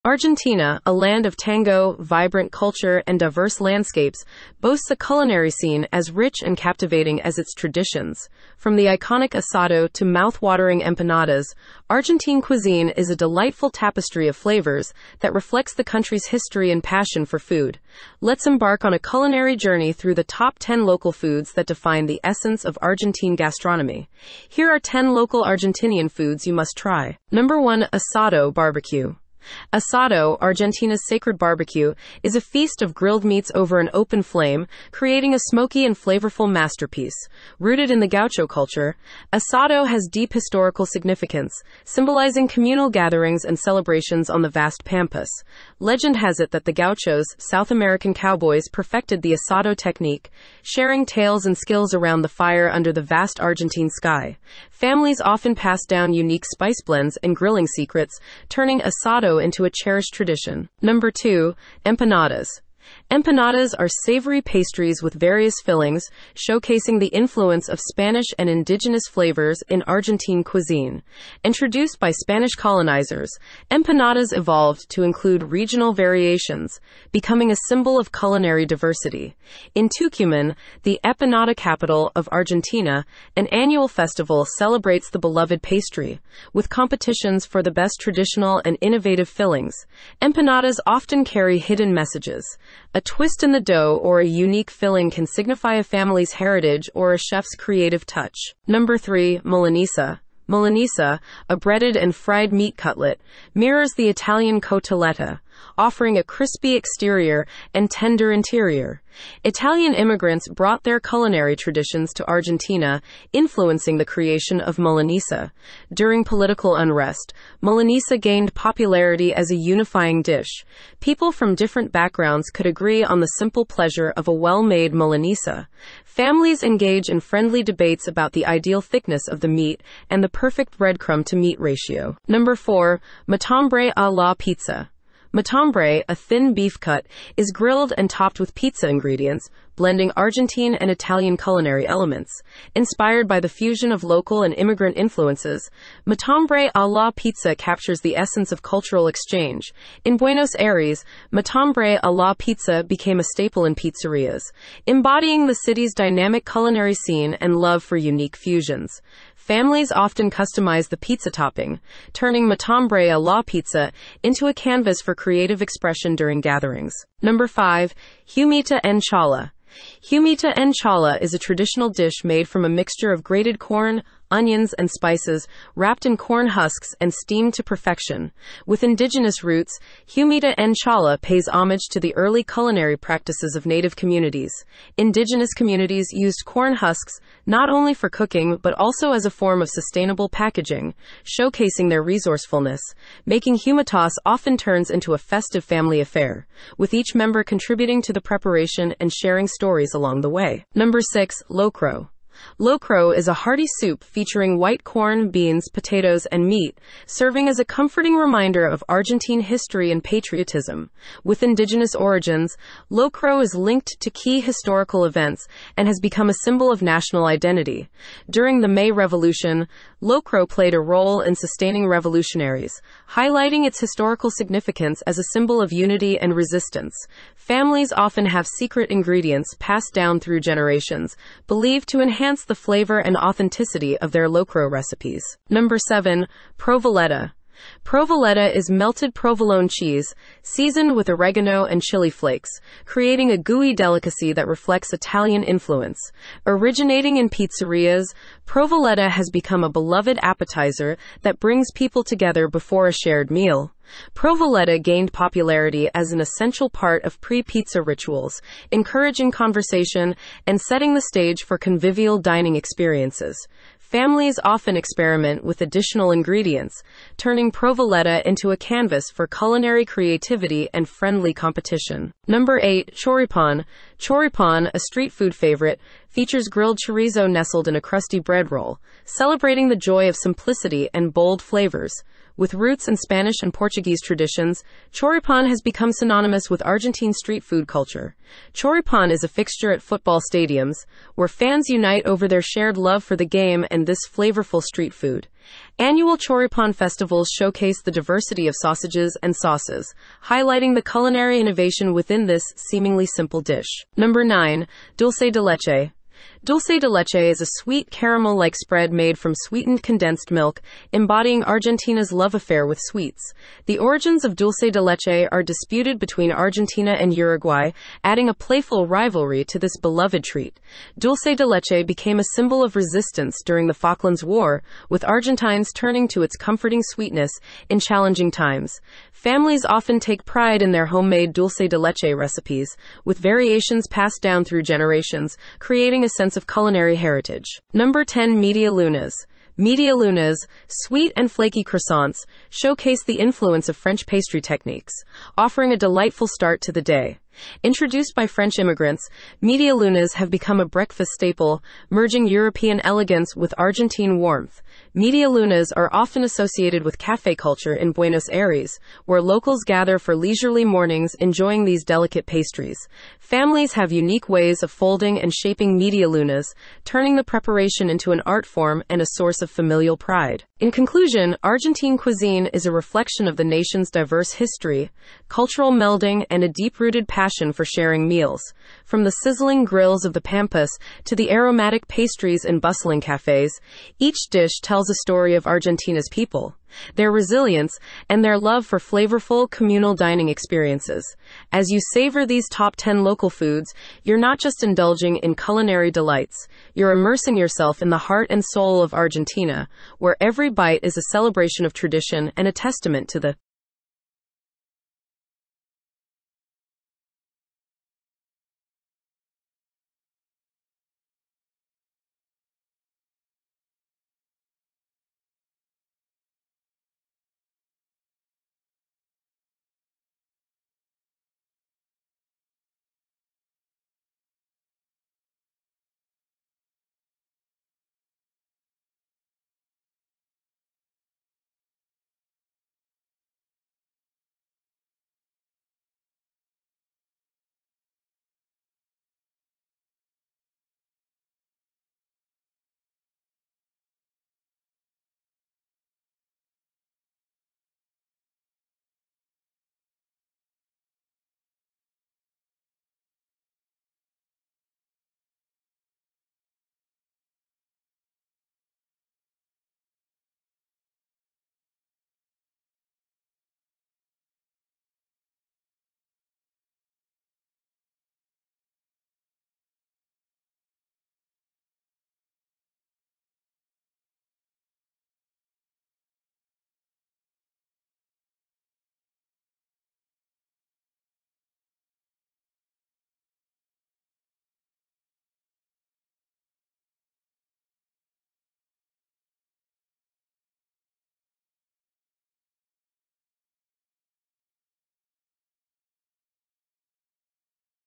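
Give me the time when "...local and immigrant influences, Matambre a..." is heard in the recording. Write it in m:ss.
2:24.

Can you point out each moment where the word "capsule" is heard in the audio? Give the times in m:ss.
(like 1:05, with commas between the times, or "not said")
not said.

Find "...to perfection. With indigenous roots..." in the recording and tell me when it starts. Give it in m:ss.
2:57.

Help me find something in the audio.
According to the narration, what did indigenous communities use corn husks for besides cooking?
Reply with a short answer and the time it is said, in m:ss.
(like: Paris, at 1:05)
sustainable packaging, at 3:09.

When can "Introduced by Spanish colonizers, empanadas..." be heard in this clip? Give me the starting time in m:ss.
1:11.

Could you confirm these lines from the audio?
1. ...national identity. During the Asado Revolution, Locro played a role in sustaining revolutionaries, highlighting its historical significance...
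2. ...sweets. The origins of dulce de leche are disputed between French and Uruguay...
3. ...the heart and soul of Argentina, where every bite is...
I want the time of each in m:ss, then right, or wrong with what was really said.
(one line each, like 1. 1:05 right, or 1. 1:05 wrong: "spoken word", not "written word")
1. 3:36 wrong: "May", not "Asado"
2. 5:12 wrong: "Argentina", not "French"
3. 6:37 right.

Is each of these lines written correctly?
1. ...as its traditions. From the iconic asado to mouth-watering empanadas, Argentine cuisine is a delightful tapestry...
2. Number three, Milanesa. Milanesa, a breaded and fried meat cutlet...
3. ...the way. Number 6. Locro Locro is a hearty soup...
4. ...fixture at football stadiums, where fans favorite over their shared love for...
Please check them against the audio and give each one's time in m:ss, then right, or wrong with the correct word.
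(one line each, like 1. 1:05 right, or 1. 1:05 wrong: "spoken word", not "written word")
1. 0:07 right
2. 1:38 right
3. 3:20 right
4. 4:49 wrong: "unite", not "favorite".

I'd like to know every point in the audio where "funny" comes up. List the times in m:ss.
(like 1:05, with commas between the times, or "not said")
not said.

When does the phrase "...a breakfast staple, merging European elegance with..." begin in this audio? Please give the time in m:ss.
5:50.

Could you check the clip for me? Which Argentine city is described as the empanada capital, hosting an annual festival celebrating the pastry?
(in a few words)
Tucumán.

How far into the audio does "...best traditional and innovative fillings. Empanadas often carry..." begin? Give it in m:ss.
1:27.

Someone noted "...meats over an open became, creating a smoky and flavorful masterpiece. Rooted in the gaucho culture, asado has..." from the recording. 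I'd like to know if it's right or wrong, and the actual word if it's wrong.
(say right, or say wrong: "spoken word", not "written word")
wrong: "flame", not "became".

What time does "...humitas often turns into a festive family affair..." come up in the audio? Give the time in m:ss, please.
3:13.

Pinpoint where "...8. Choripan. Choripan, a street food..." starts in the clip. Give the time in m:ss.
4:32.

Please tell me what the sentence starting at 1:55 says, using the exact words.
During political unrest, Milanesa gained popularity as a unifying dish.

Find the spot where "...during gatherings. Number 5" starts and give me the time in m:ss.
2:46.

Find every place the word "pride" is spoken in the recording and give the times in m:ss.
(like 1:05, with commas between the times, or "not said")
5:30, 6:09.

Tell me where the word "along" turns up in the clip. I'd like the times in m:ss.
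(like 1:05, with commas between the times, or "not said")
3:19.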